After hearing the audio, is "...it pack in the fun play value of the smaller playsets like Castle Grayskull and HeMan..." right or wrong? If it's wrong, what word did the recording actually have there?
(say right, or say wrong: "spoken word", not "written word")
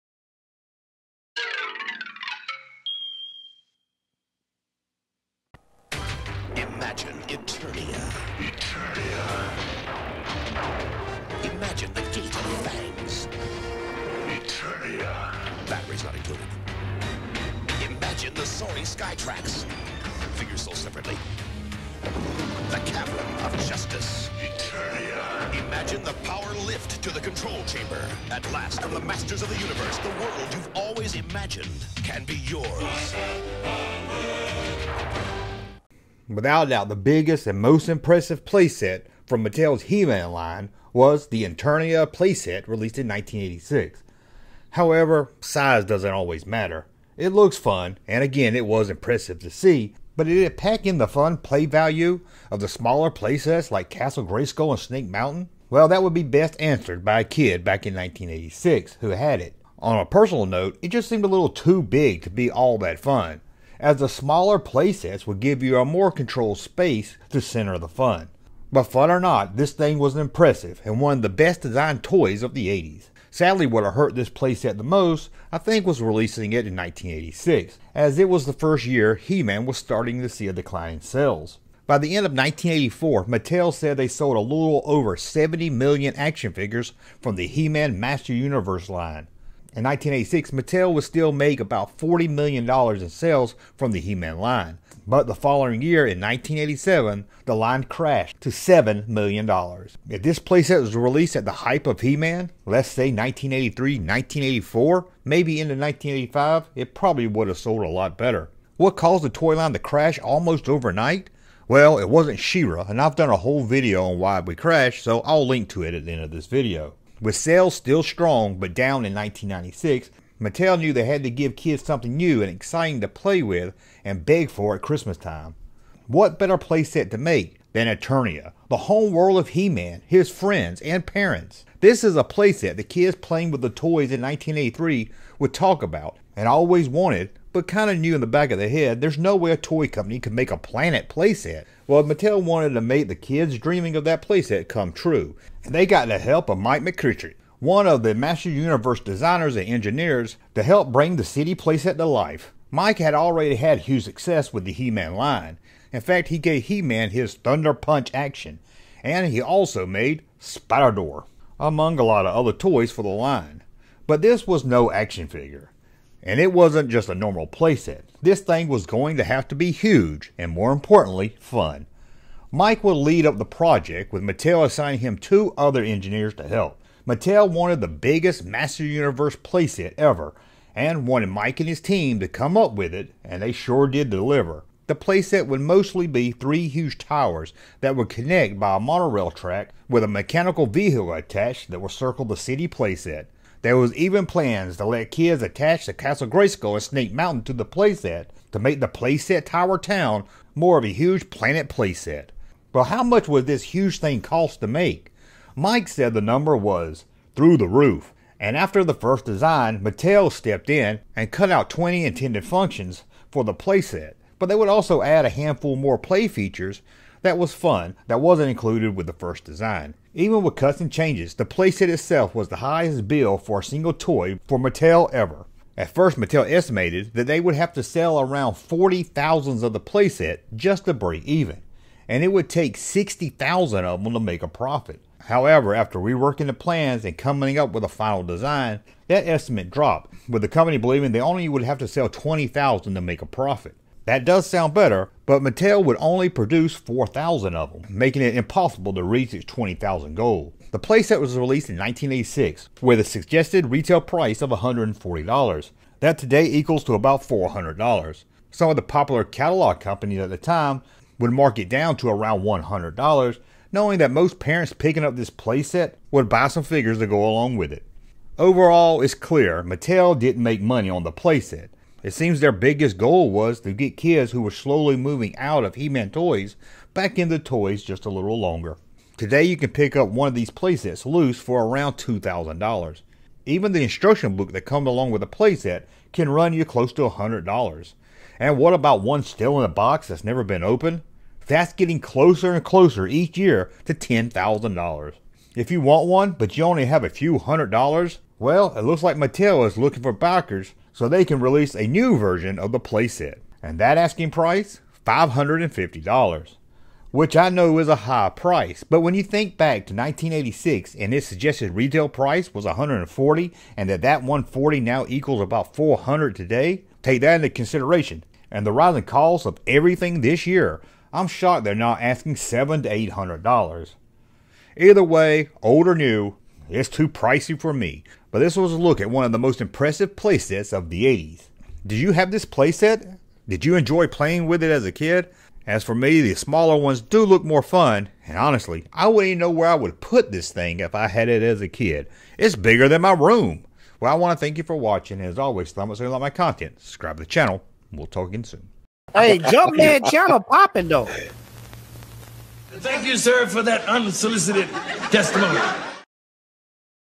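wrong: "Snake", not "HeMan".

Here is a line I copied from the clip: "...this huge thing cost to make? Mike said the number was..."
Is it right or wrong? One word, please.
right.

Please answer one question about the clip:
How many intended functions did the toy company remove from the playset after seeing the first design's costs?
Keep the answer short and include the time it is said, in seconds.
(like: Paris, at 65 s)
20, at 211 s.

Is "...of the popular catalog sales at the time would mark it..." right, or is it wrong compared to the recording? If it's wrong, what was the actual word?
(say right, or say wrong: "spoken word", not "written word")
wrong: "companies", not "sales".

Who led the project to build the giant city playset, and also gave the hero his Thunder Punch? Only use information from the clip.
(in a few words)
Mike McCritchie.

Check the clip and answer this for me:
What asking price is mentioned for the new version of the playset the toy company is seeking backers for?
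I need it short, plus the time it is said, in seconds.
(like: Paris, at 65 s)
$550, at 305 s.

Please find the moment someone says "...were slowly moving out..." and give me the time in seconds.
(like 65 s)
274 s.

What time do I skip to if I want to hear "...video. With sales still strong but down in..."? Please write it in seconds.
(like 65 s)
116 s.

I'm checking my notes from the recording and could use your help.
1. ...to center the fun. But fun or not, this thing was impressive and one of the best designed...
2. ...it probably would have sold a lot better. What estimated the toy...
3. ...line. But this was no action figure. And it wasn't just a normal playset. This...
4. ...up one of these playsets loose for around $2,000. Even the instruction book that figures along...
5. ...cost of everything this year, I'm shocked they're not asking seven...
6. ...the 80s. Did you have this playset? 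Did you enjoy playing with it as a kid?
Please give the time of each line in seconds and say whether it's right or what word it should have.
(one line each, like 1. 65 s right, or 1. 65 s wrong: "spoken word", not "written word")
1. 67 s right
2. 106 s wrong: "caused", not "estimated"
3. 163 s right
4. 279 s wrong: "comes", not "figures"
5. 319 s right
6. 330 s right.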